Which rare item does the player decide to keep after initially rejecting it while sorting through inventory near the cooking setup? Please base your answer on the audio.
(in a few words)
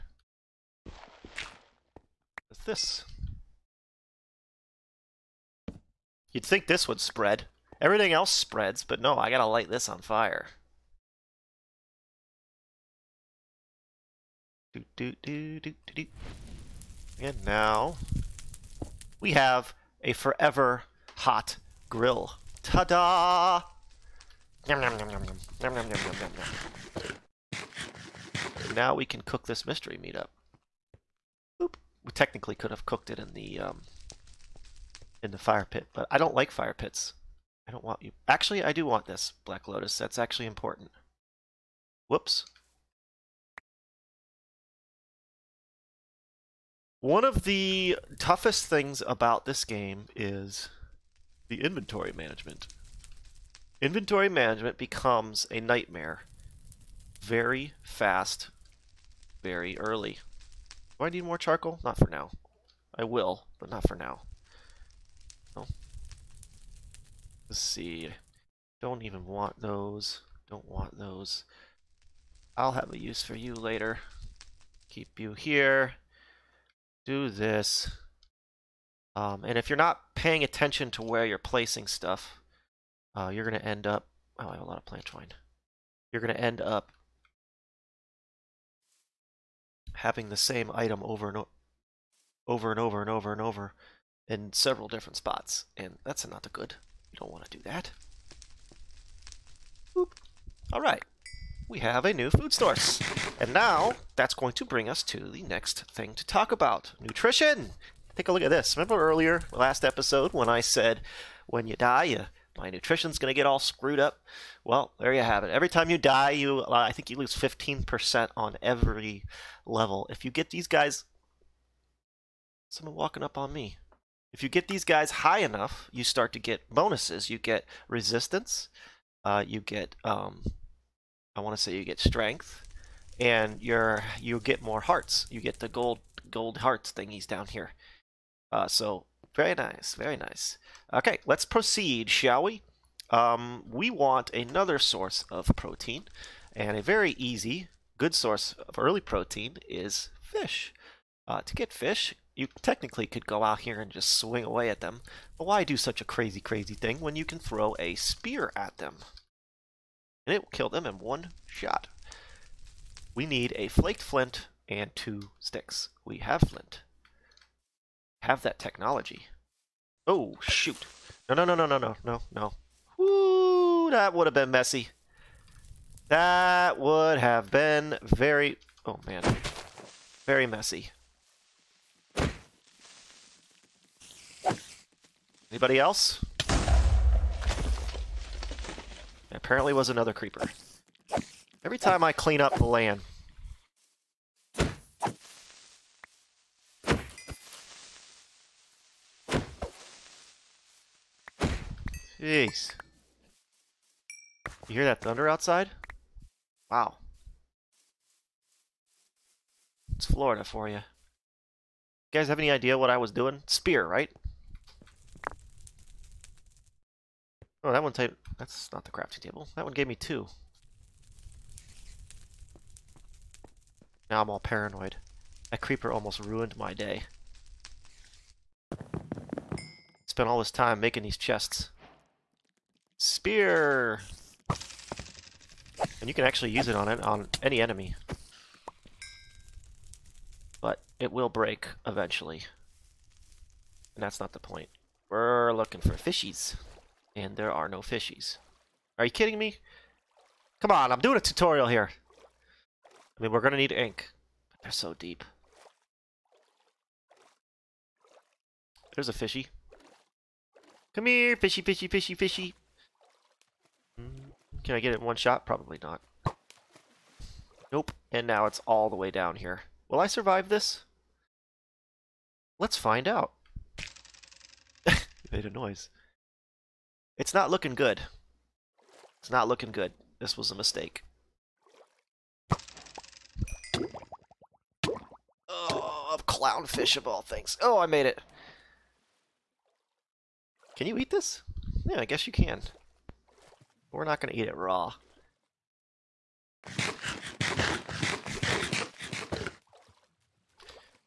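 Black Lotus.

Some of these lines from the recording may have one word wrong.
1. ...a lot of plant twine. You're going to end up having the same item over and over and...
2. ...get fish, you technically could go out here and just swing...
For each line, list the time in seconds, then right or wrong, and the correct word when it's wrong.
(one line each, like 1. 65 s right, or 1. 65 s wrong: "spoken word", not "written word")
1. 84 s right
2. 151 s right.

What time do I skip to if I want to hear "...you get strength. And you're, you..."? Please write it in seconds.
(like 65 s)
131 s.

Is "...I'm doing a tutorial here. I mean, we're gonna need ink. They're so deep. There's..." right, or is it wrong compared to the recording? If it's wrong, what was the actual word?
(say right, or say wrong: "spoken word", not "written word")
right.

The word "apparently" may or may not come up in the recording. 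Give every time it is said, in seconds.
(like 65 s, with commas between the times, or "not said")
189 s.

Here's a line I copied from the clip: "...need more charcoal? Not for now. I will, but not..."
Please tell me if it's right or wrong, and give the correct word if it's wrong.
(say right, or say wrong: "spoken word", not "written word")
right.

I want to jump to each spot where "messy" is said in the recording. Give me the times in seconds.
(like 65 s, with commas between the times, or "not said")
174 s, 180 s.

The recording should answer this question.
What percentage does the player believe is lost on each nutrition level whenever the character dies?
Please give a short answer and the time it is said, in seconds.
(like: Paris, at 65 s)
15%, at 117 s.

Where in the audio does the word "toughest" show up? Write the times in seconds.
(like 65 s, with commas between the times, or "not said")
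48 s.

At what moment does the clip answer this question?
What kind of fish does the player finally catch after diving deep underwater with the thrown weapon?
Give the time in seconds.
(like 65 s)
286 s.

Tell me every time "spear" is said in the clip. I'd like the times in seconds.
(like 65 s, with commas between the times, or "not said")
157 s, 213 s, 232 s.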